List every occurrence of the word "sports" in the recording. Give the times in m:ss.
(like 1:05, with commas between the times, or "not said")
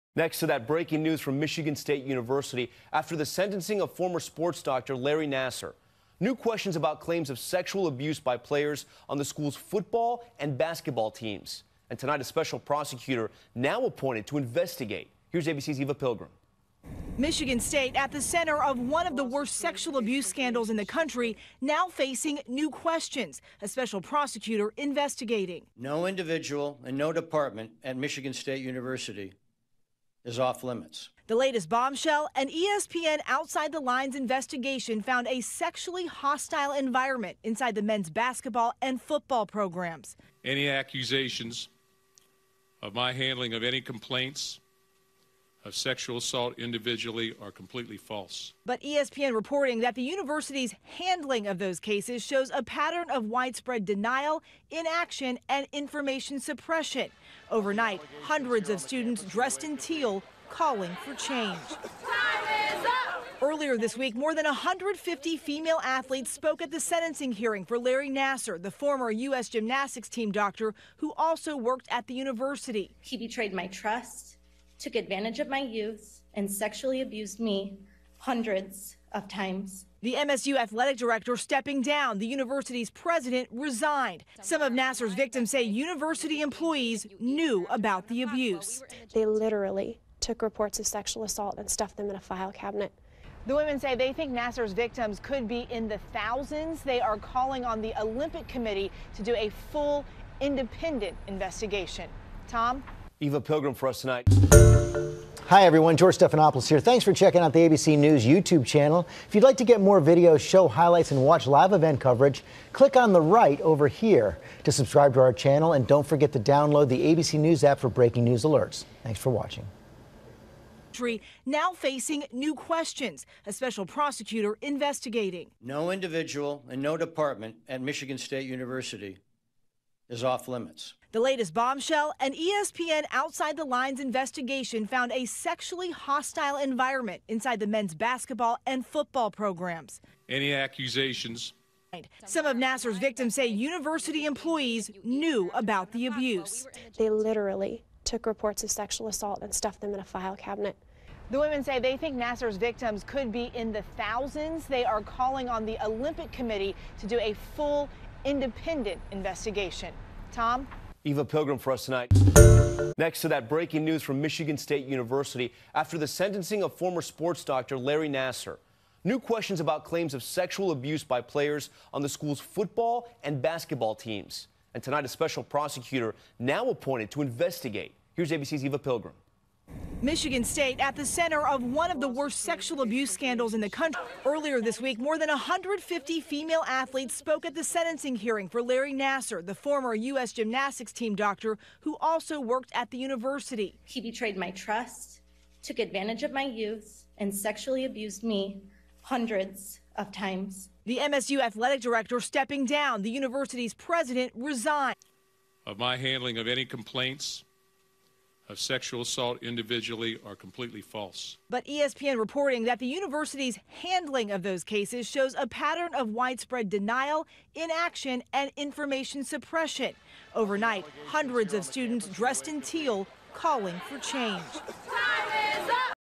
0:04, 2:47.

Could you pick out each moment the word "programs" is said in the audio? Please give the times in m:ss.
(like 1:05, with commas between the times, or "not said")
0:39, 2:19.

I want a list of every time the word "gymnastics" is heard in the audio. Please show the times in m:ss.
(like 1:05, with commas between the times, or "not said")
1:09, 3:10.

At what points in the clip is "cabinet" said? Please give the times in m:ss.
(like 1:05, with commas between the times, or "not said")
1:32, 2:30.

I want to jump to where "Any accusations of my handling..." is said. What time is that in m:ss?
0:40.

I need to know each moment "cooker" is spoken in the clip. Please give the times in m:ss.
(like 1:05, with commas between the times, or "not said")
not said.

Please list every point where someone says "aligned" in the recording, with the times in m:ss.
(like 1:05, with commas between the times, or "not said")
not said.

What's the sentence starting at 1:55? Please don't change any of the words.
And don't forget to download the ABC News app for breaking news alerts.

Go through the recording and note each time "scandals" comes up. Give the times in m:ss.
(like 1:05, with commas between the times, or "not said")
0:20, 3:03.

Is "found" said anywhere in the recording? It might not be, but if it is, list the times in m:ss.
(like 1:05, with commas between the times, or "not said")
0:35, 2:14.